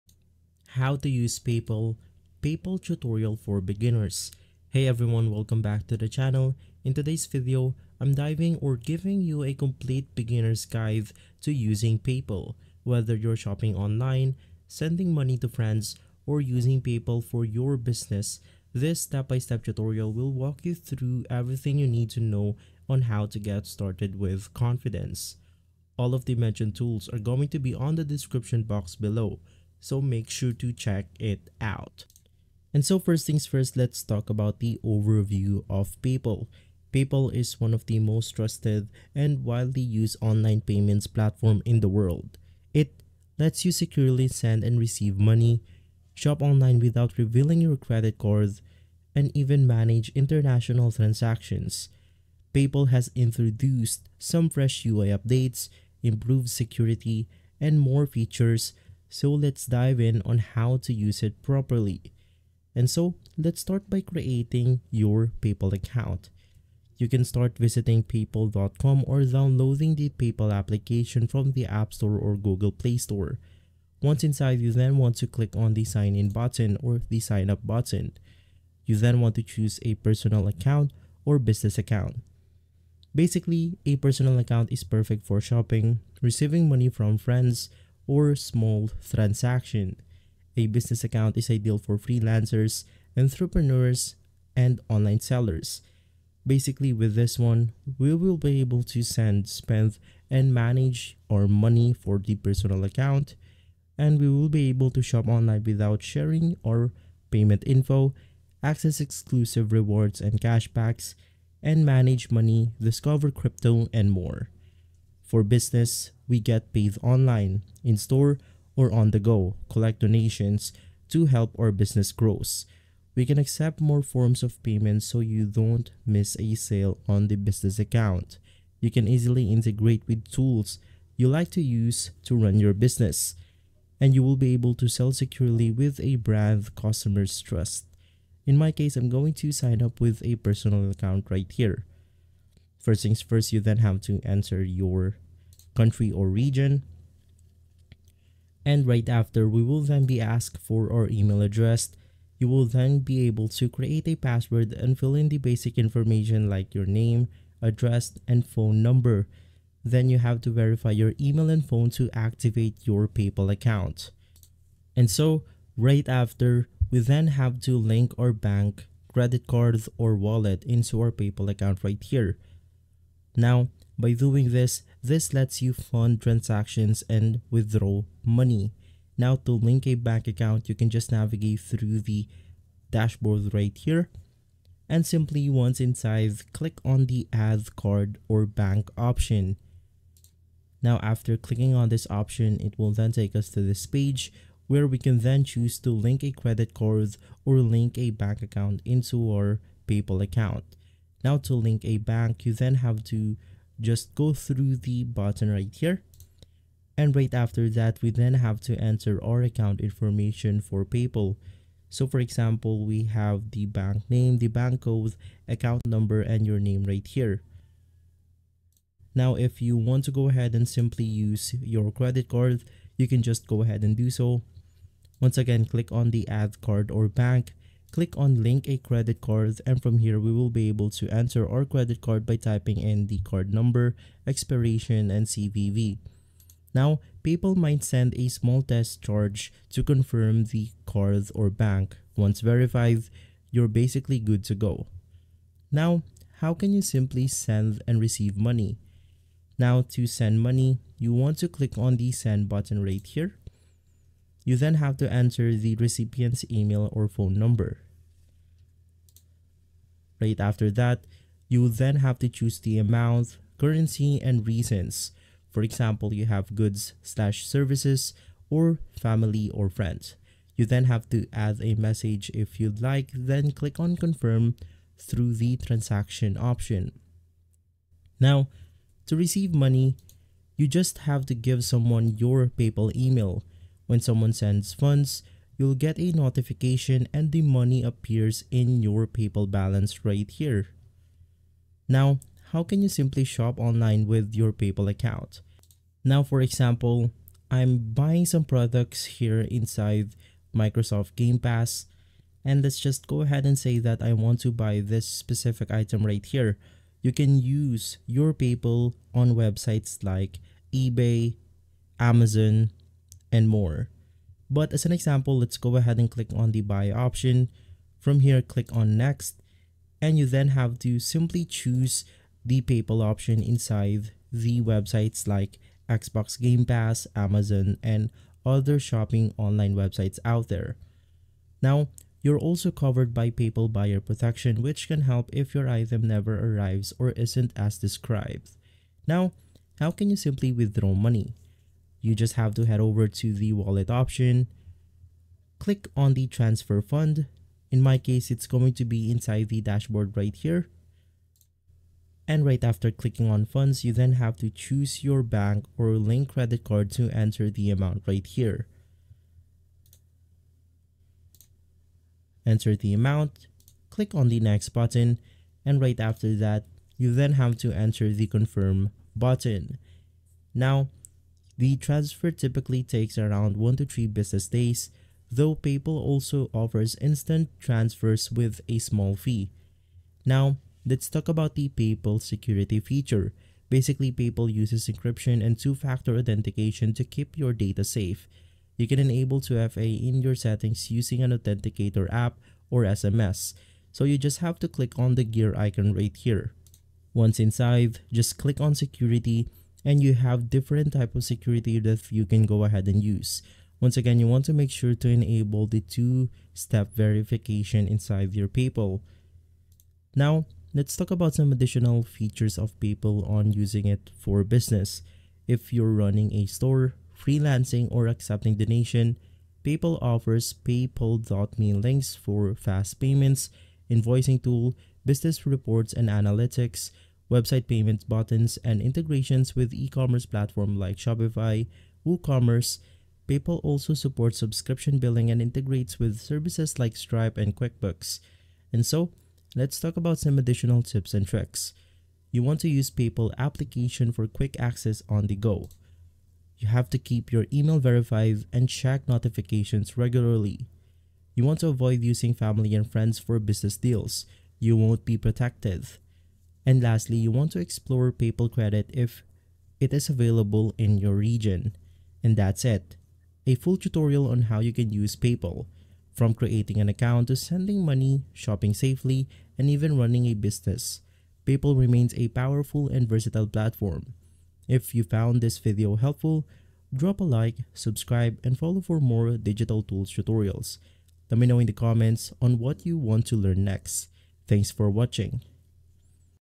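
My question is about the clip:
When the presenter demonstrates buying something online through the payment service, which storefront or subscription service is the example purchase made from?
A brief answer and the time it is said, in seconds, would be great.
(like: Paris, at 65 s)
Microsoft Game Pass, at 300 s.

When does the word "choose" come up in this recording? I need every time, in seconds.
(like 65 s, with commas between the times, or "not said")
79 s, 195 s, 262 s, 321 s, 354 s.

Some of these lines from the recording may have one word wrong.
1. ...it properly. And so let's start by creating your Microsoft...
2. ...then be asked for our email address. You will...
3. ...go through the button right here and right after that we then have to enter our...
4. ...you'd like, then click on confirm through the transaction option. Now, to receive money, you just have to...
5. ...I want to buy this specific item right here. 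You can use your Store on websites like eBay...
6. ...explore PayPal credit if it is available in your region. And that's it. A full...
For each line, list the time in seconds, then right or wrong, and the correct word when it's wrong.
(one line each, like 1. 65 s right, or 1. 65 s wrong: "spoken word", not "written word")
1. 61 s wrong: "PayPal", not "Microsoft"
2. 149 s right
3. 204 s right
4. 272 s right
5. 304 s wrong: "PayPal", not "Store"
6. 457 s right.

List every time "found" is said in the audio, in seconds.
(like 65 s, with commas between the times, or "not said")
475 s.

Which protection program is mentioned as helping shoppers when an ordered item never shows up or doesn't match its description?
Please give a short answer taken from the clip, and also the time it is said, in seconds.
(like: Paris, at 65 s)
buyer protection, at 333 s.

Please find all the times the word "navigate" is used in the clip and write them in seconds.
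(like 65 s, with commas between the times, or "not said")
181 s.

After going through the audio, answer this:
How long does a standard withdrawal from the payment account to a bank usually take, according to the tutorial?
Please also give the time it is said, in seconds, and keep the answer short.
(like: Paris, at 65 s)
1 to 3 business days, at 373 s.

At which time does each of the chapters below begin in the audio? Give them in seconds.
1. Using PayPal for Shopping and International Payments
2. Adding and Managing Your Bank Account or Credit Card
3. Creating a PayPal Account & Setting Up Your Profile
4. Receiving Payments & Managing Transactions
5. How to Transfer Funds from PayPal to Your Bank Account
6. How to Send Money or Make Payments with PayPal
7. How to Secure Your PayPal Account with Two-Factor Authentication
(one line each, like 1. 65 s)
1. 430 s
2. 90 s
3. 45 s
4. 240 s
5. 360 s
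6. 170 s
7. 300 s.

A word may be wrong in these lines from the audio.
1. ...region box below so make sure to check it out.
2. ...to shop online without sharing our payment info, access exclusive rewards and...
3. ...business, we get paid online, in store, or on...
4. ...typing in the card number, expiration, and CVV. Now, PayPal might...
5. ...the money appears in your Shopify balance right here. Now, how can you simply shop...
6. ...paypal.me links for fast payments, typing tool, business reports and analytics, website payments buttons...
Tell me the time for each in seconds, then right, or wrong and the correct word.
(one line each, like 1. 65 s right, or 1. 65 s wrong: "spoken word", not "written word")
1. 28 s wrong: "description", not "region"
2. 104 s right
3. 115 s right
4. 232 s right
5. 287 s wrong: "PayPal", not "Shopify"
6. 420 s wrong: "invoicing", not "typing".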